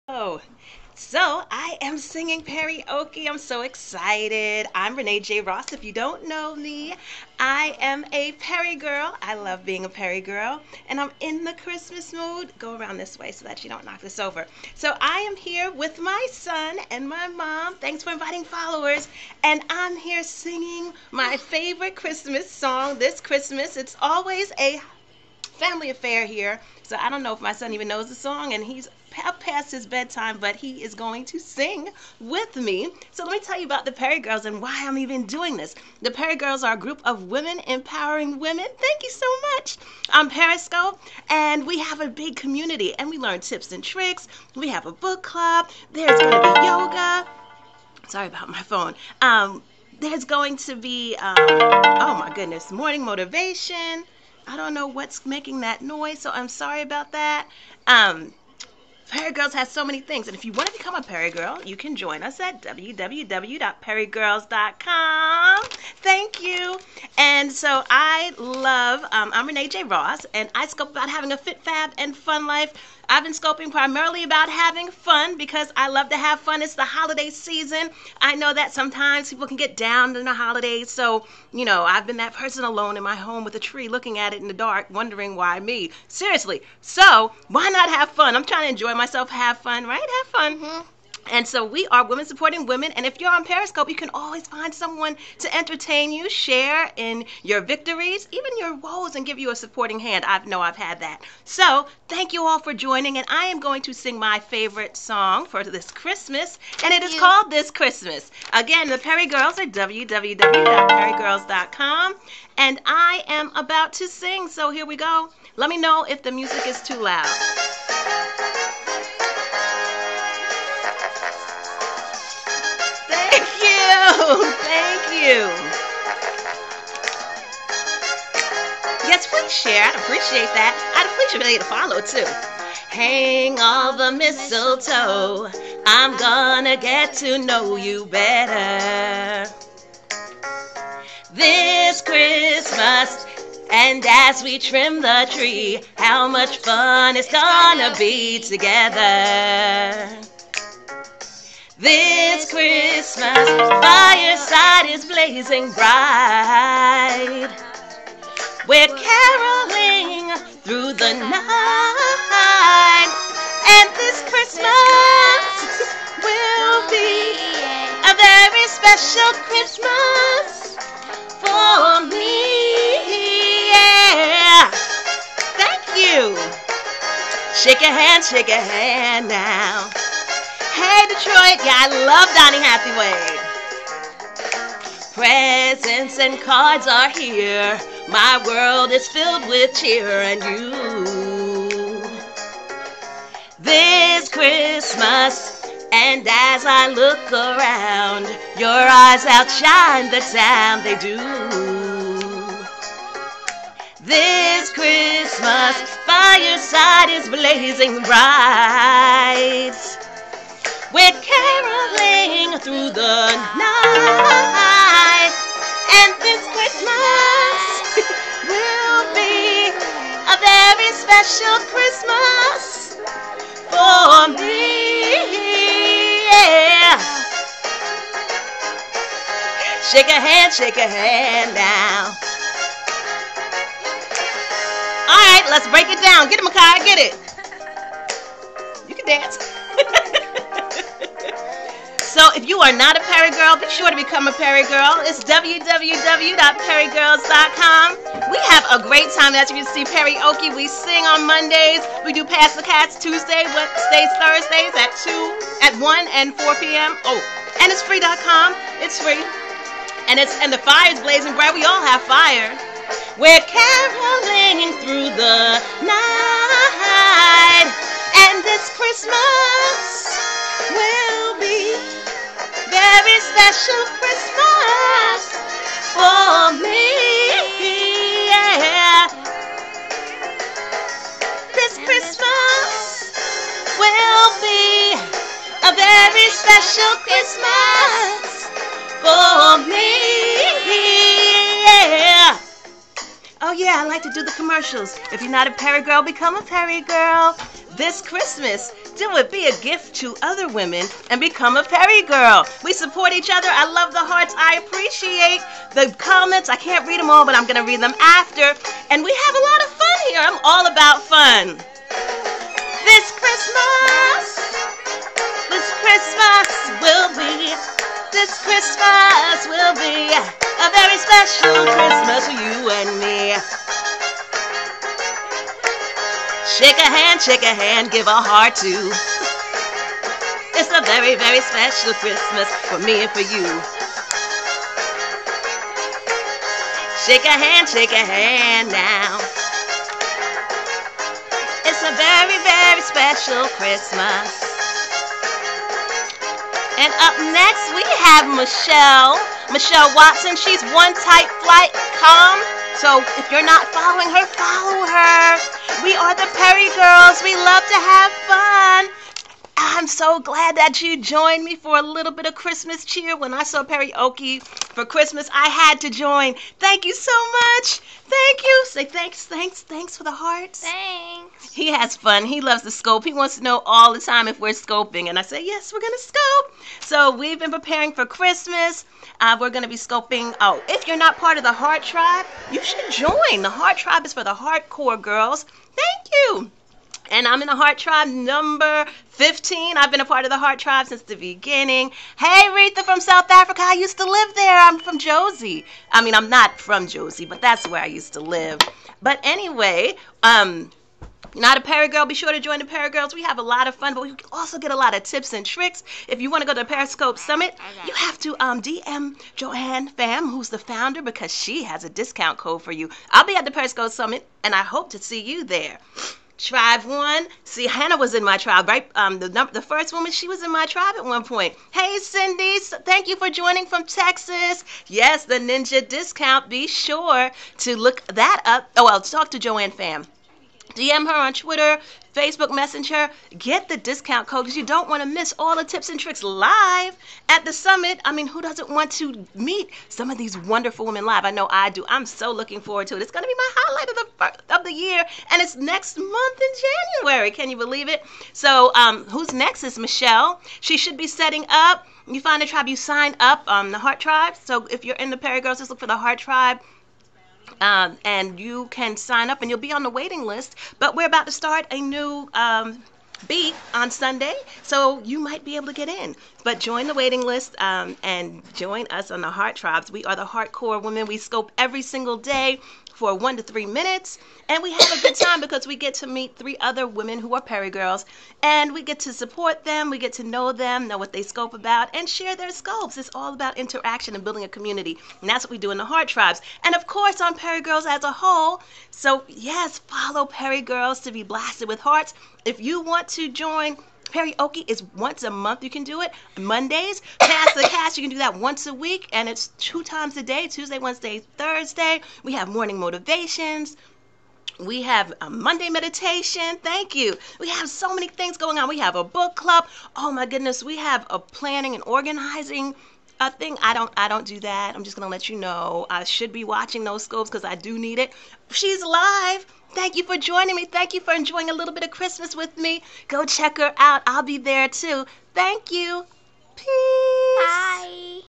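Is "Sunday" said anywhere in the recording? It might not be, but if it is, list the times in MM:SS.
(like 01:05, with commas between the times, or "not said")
07:43.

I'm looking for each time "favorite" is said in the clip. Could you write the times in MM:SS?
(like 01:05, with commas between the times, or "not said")
00:21, 01:44.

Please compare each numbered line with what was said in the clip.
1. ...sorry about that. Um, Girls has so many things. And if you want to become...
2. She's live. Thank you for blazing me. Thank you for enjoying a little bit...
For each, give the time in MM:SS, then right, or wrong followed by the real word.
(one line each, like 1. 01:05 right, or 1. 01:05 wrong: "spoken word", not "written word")
1. 00:56 right
2. 08:38 wrong: "joining", not "blazing".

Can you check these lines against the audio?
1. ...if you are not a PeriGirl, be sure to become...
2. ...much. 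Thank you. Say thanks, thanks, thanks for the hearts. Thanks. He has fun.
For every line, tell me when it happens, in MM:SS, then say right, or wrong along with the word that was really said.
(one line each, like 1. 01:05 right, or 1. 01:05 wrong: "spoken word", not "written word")
1. 04:02 right
2. 06:07 right.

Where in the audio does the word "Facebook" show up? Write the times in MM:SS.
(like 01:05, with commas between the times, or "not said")
07:12.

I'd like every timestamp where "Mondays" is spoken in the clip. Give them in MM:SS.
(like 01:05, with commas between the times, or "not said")
04:11, 08:16, 08:25.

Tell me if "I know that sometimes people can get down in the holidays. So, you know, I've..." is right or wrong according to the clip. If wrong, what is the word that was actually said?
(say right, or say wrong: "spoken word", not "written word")
right.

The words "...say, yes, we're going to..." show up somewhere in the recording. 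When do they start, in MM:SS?
06:15.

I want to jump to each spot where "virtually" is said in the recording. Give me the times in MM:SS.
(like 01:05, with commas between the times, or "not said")
not said.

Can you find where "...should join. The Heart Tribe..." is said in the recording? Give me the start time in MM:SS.
06:22.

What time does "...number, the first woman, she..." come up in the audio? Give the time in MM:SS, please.
06:59.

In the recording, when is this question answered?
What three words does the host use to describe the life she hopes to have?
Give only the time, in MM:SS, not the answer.
01:11.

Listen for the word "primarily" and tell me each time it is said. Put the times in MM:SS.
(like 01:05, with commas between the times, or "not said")
01:13.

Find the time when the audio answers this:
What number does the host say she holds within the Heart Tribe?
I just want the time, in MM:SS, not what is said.
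06:28.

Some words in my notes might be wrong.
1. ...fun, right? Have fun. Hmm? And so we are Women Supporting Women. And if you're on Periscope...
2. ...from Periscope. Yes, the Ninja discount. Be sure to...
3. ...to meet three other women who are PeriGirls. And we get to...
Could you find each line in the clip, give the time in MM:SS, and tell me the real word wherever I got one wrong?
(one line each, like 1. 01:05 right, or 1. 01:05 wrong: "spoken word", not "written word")
1. 01:29 right
2. 07:03 wrong: "Texas", not "Periscope"
3. 07:55 right.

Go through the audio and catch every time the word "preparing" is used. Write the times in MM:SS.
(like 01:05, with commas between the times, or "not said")
06:17.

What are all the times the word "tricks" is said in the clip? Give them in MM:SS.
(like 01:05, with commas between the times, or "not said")
00:43, 06:45, 07:15.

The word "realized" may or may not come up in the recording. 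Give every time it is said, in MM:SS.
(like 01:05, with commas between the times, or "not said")
not said.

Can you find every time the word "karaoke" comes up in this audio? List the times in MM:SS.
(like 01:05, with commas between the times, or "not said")
00:02, 06:03, 08:14.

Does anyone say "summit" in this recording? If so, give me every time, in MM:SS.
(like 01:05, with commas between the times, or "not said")
06:47, 06:53, 07:17.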